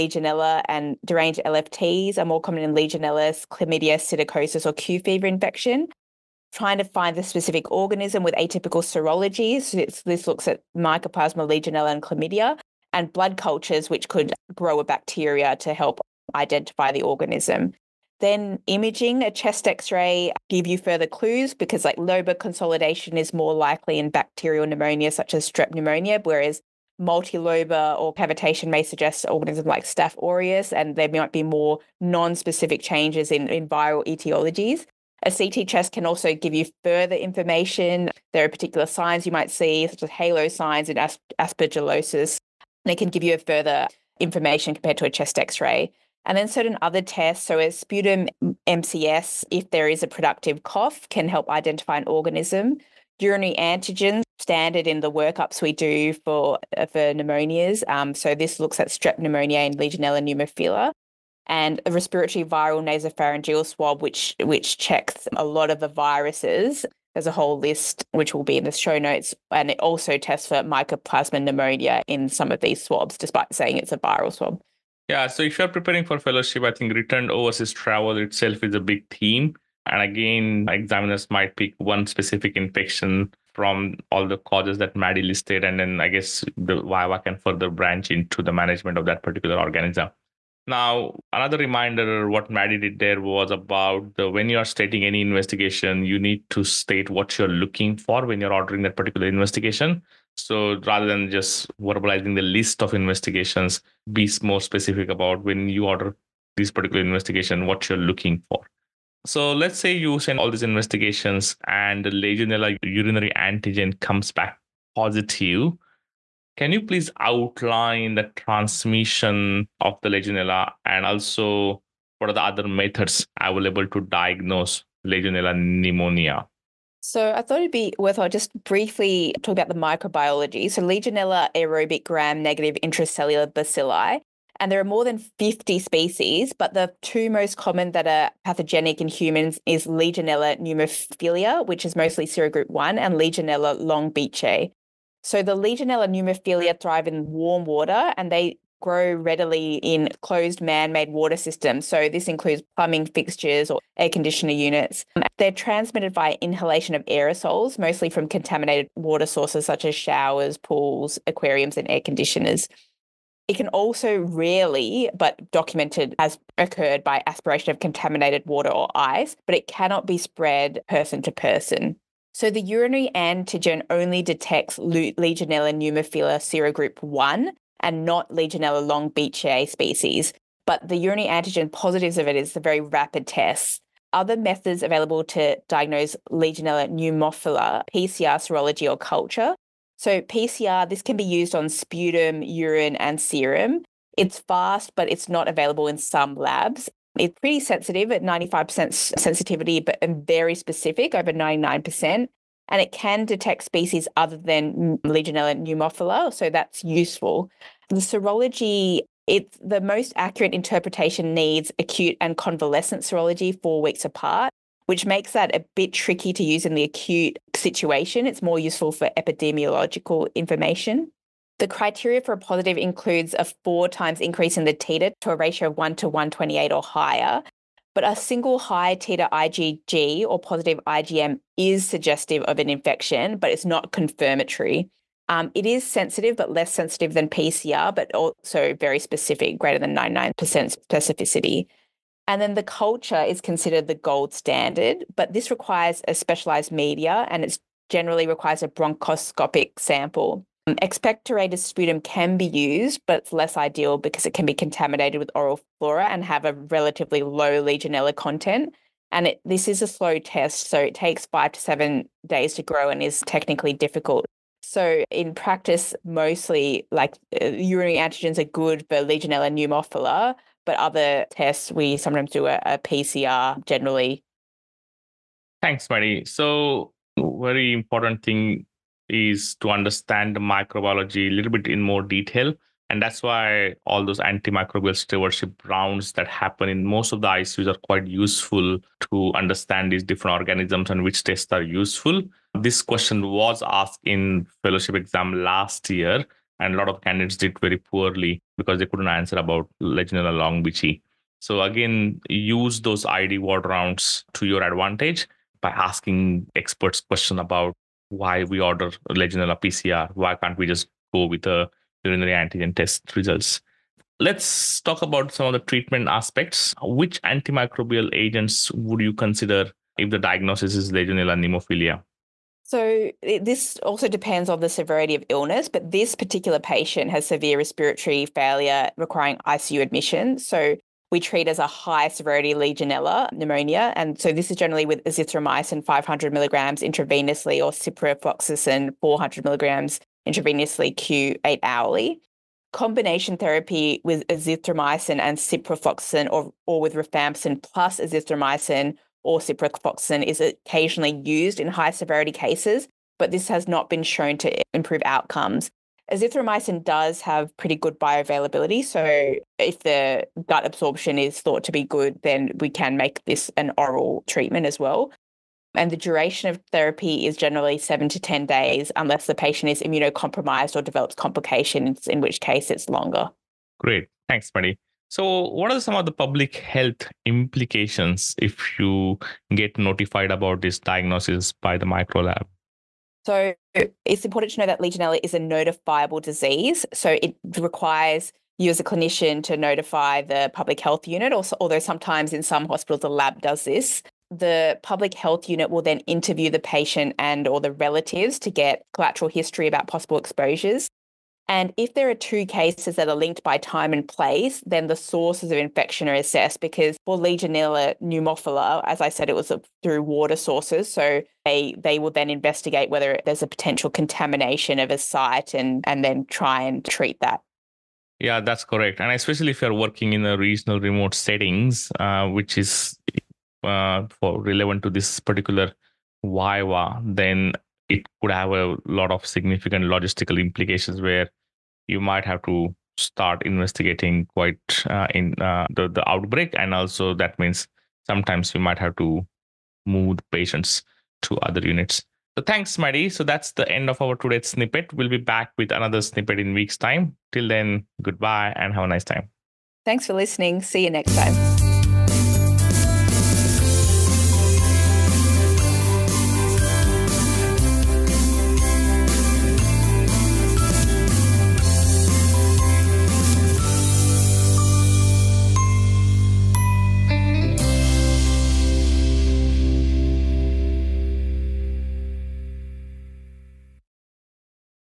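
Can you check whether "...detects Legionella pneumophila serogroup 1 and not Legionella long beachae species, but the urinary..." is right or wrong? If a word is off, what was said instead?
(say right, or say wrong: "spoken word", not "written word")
right.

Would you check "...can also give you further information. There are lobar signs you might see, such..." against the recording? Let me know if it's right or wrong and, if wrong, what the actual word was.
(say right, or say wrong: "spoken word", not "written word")
wrong: "particular", not "lobar".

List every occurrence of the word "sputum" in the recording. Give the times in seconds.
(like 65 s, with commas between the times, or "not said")
47 s, 191 s, 251 s.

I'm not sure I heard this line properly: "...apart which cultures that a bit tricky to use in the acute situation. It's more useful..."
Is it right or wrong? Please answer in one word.
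wrong.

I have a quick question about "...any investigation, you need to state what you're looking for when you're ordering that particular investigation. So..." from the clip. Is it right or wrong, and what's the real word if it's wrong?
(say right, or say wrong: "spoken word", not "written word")
right.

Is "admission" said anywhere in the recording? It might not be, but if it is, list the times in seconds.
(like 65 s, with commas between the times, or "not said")
329 s.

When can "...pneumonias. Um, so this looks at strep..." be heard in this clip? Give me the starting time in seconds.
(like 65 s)
57 s.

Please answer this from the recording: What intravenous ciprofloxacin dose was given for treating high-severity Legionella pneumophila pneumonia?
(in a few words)
400 milligrams.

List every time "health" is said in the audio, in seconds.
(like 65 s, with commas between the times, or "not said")
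376 s, 390 s, 395 s.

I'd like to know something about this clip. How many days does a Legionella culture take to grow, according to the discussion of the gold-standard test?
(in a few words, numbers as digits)
5 to 7 days.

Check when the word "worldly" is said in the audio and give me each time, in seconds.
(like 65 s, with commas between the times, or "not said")
not said.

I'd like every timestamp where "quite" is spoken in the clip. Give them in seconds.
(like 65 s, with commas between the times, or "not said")
287 s, 434 s.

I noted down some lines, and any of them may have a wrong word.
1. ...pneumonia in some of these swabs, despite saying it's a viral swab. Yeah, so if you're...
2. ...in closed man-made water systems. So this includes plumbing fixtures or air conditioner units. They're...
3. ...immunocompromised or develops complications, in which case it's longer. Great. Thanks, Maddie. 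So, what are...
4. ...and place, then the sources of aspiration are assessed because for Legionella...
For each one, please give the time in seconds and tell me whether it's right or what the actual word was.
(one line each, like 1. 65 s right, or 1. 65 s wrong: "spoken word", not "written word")
1. 71 s right
2. 149 s right
3. 369 s right
4. 403 s wrong: "infection", not "aspiration".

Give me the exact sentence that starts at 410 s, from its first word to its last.
So they, they will then investigate whether there's a potential contamination of a site and, and then try and treat that.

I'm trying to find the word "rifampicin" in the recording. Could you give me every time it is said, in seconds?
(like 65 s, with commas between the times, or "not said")
346 s.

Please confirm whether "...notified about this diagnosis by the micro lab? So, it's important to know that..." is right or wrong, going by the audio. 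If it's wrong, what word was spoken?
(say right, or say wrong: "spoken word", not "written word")
right.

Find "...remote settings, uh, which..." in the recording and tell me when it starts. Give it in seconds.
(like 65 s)
420 s.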